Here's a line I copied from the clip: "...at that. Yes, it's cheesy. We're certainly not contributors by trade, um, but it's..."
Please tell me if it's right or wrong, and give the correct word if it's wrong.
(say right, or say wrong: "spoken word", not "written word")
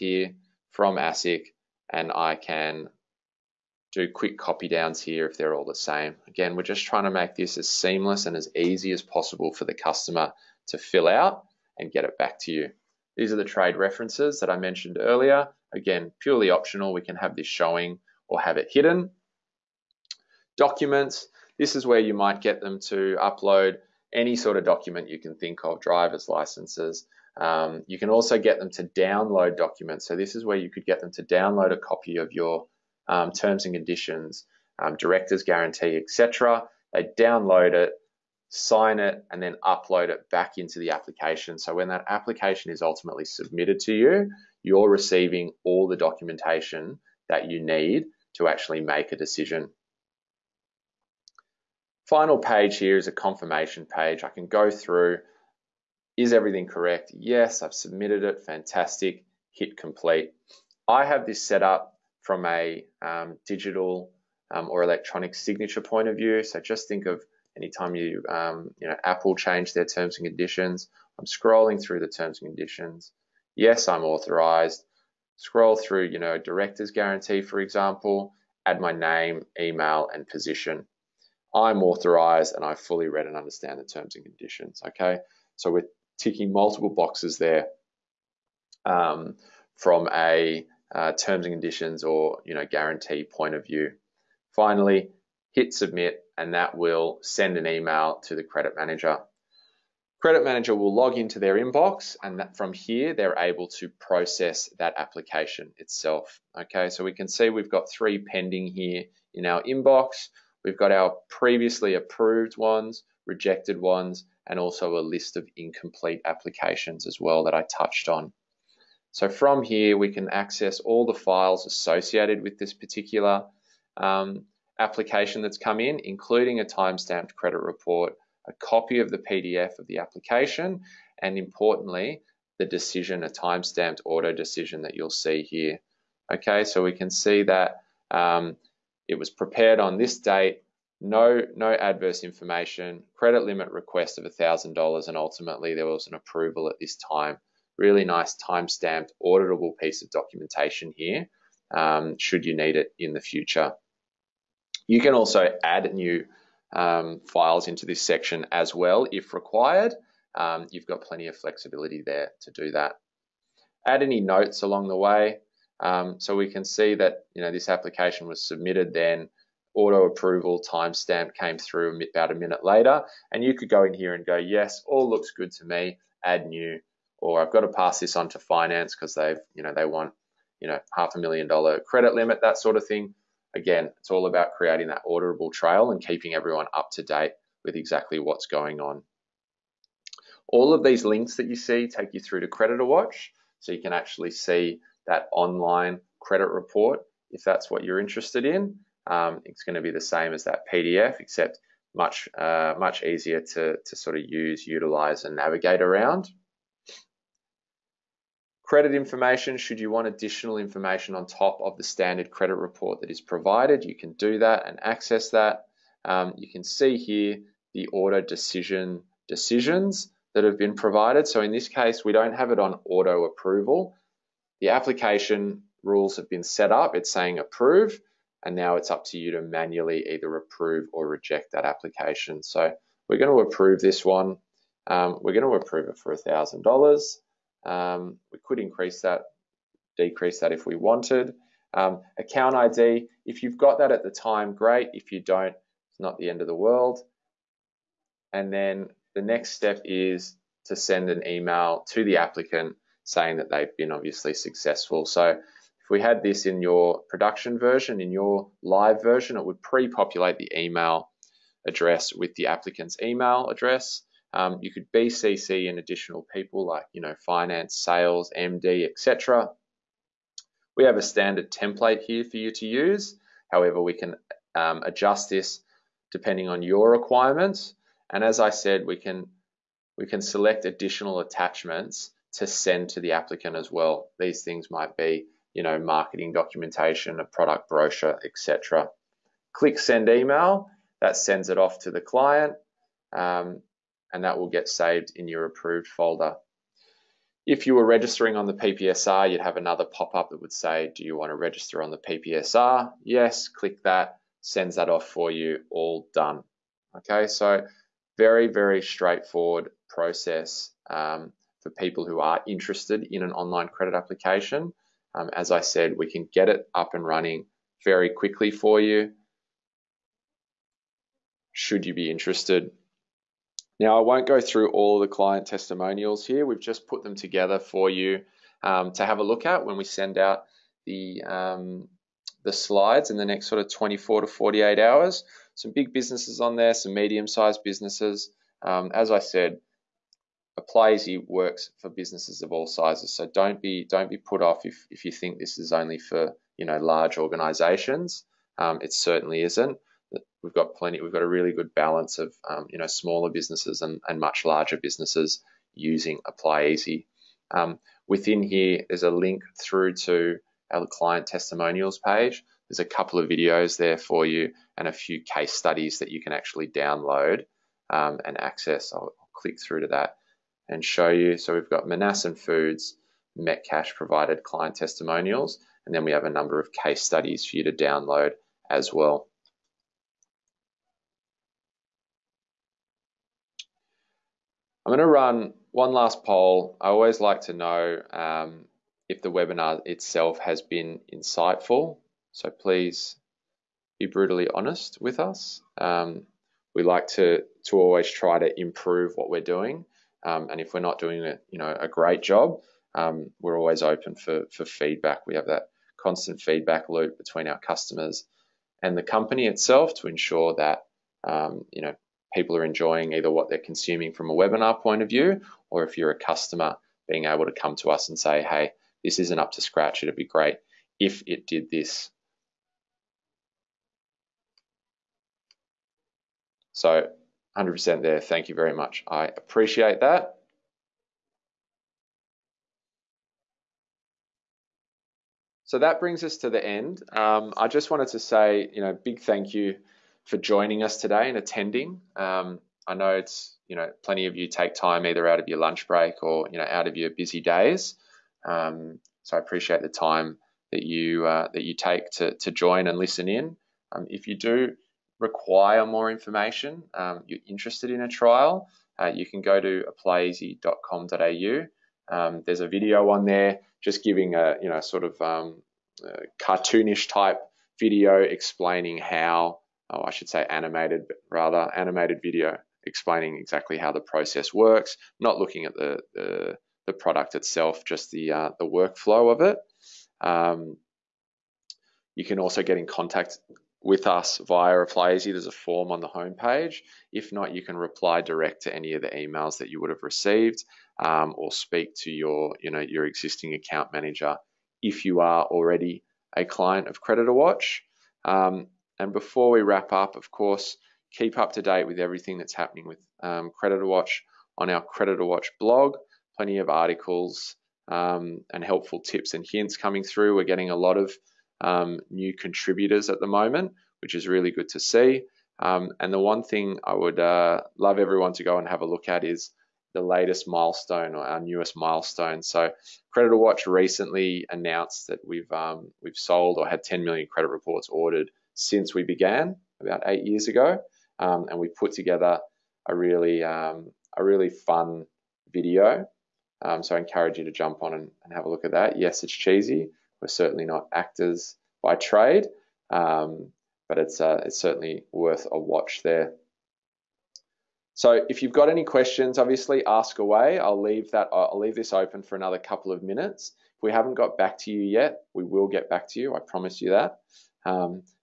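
wrong: "actors", not "contributors".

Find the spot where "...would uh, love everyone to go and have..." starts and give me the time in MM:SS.
08:36.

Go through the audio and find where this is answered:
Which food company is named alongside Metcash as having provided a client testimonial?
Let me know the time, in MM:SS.
06:11.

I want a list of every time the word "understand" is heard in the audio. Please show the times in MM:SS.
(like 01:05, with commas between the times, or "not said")
01:23.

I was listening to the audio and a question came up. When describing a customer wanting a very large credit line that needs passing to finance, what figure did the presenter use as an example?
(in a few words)
half a million dollar.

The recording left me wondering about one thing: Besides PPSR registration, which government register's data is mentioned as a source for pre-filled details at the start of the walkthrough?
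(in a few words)
ASIC.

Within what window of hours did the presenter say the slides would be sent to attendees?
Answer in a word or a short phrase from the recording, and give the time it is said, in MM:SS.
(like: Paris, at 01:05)
24 to 48 hours, at 05:33.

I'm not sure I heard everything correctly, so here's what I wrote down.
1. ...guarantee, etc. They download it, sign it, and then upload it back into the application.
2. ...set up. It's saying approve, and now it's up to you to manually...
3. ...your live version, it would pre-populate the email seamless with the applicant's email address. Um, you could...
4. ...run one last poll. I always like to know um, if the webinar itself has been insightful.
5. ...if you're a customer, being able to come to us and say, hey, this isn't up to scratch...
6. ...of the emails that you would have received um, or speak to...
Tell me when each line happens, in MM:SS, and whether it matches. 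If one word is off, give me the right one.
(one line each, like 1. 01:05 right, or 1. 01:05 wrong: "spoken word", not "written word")
1. 00:35 right
2. 03:46 right
3. 04:18 wrong: "address", not "seamless"
4. 06:25 right
5. 06:55 right
6. 08:08 right.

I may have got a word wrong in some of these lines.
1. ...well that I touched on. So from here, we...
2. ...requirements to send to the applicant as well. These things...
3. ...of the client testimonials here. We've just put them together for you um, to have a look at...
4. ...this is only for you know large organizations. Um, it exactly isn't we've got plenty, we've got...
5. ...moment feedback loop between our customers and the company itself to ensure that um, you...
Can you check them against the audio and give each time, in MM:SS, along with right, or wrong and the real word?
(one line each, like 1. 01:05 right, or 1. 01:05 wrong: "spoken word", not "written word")
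1. 01:57 right
2. 04:41 wrong: "attachments", not "requirements"
3. 05:25 right
4. 05:45 wrong: "certainly", not "exactly"
5. 06:45 wrong: "constant", not "moment".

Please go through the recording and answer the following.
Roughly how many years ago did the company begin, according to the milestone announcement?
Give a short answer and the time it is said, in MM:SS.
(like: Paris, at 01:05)
8, at 08:50.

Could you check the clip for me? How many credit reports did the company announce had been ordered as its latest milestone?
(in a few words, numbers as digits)
10 million.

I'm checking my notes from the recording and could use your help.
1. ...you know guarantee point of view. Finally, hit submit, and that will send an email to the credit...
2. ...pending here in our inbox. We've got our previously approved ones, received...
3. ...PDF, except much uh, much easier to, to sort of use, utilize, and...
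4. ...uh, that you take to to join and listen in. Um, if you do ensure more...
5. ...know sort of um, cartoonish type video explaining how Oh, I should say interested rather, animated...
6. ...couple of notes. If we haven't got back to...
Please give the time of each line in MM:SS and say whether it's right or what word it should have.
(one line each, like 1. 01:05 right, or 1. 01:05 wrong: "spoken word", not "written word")
1. 01:32 right
2. 01:48 wrong: "rejected", not "received"
3. 03:20 right
4. 07:31 wrong: "require", not "ensure"
5. 07:44 wrong: "animated", not "interested"
6. 09:12 wrong: "minutes", not "notes".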